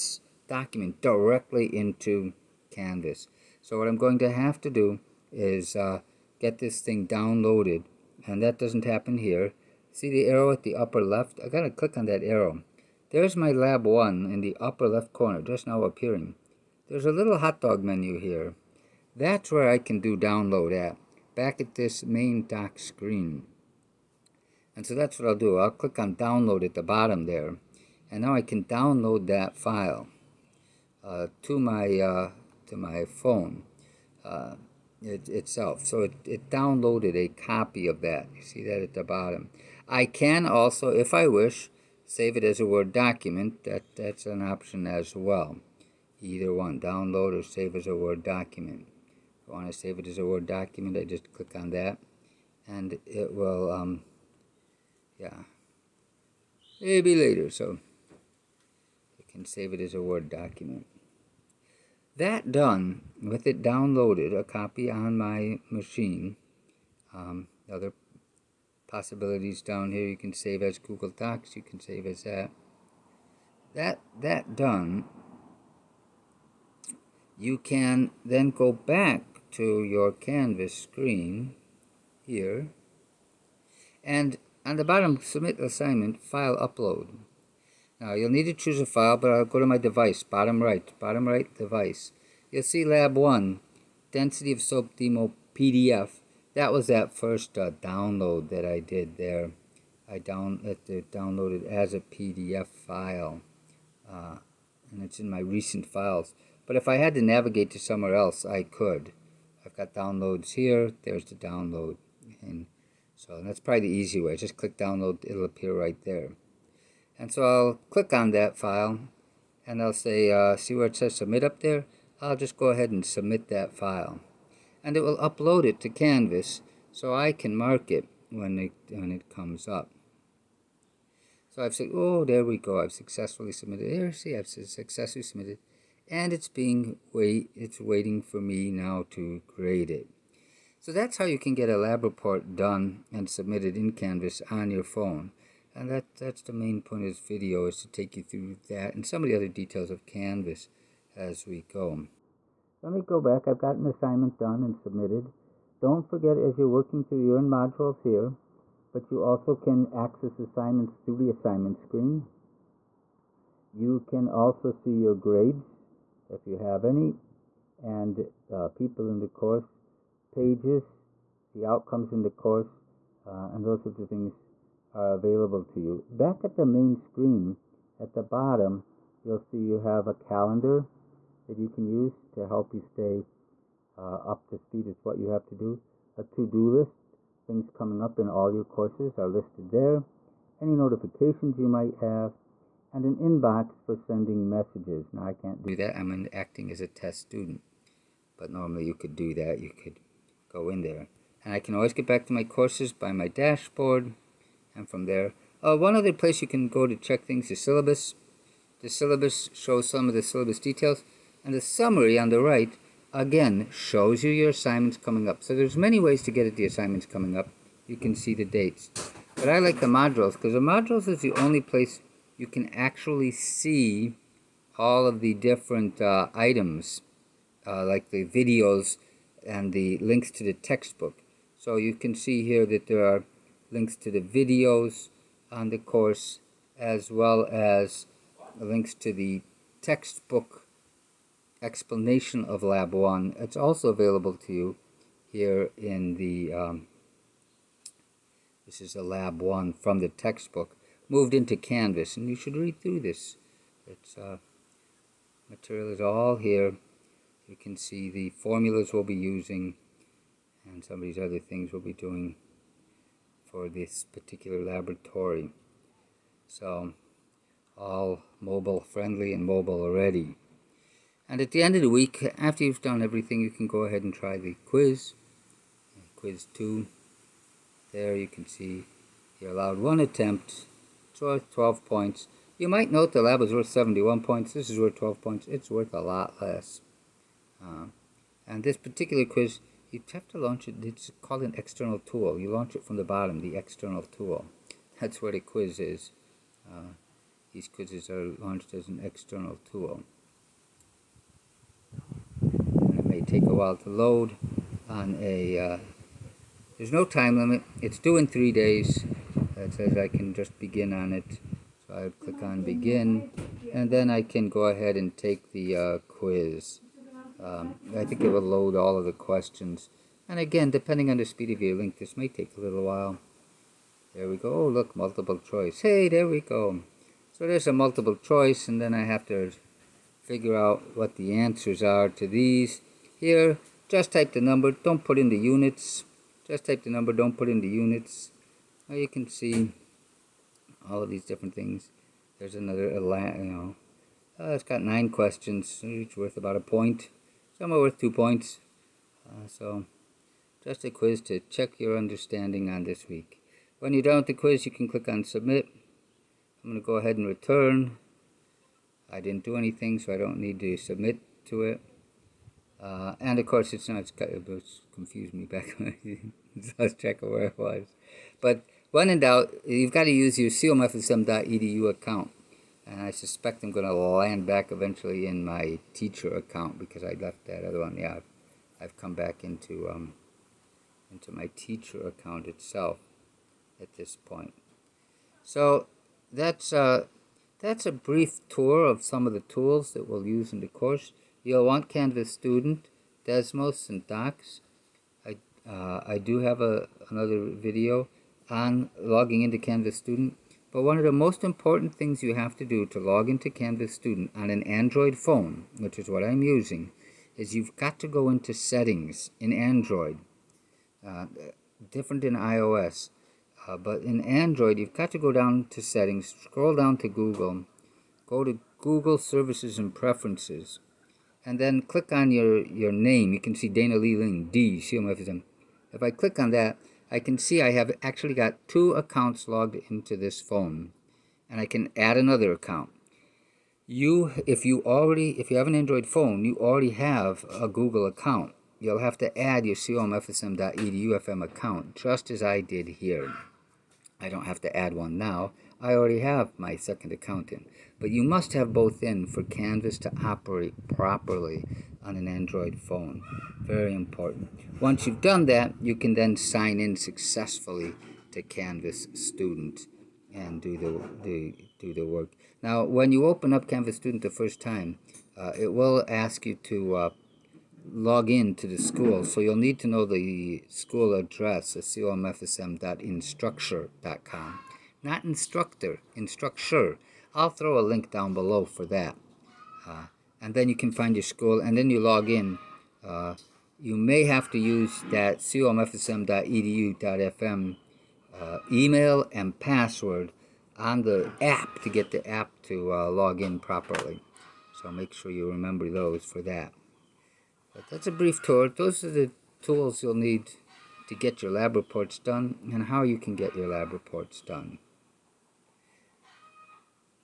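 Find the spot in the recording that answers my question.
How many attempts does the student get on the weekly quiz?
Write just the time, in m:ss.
4:39.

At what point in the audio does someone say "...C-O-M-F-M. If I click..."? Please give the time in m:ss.
7:04.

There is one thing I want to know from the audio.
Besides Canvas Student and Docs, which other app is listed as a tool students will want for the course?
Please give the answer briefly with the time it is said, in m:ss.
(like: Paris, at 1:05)
Desmos, at 6:33.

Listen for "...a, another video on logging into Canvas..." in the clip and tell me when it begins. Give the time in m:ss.
6:36.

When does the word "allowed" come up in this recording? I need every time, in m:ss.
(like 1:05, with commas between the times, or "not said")
4:39.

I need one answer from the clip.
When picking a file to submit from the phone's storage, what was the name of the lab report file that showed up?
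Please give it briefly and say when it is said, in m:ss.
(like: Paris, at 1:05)
Lab one, density of soap demo, at 1:32.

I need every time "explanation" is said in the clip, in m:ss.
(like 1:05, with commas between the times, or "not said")
4:01.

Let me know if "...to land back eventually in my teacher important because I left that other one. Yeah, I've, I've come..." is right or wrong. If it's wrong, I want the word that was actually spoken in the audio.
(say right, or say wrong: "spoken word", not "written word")
wrong: "account", not "important".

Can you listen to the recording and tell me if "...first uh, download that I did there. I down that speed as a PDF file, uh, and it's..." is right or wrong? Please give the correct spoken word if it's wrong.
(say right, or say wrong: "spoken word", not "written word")
wrong: "downloaded", not "speed".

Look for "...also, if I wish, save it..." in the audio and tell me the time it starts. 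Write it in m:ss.
0:40.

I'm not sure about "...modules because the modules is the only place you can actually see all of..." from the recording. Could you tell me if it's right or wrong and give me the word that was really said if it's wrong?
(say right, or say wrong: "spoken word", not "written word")
right.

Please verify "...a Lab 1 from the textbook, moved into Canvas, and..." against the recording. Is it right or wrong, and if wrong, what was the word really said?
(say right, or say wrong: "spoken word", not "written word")
right.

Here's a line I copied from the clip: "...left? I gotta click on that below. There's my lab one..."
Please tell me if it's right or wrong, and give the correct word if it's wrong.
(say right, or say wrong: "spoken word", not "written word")
wrong: "arrow", not "below".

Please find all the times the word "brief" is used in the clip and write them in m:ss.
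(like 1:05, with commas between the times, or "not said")
6:27, 8:18.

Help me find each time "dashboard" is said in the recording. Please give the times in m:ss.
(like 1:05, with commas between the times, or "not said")
3:23.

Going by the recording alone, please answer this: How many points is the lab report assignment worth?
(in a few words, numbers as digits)
71.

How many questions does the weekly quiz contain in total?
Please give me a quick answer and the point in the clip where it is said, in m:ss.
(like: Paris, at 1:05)
9, at 5:44.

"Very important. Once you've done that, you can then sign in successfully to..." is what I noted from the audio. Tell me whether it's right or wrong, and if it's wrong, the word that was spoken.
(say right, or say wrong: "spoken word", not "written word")
right.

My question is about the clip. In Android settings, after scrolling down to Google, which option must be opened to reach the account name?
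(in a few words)
Google Services and Preferences.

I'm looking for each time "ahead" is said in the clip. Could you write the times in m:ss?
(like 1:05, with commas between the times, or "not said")
2:02, 4:33, 5:14, 5:56.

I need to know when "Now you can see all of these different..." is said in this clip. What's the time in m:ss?
5:38.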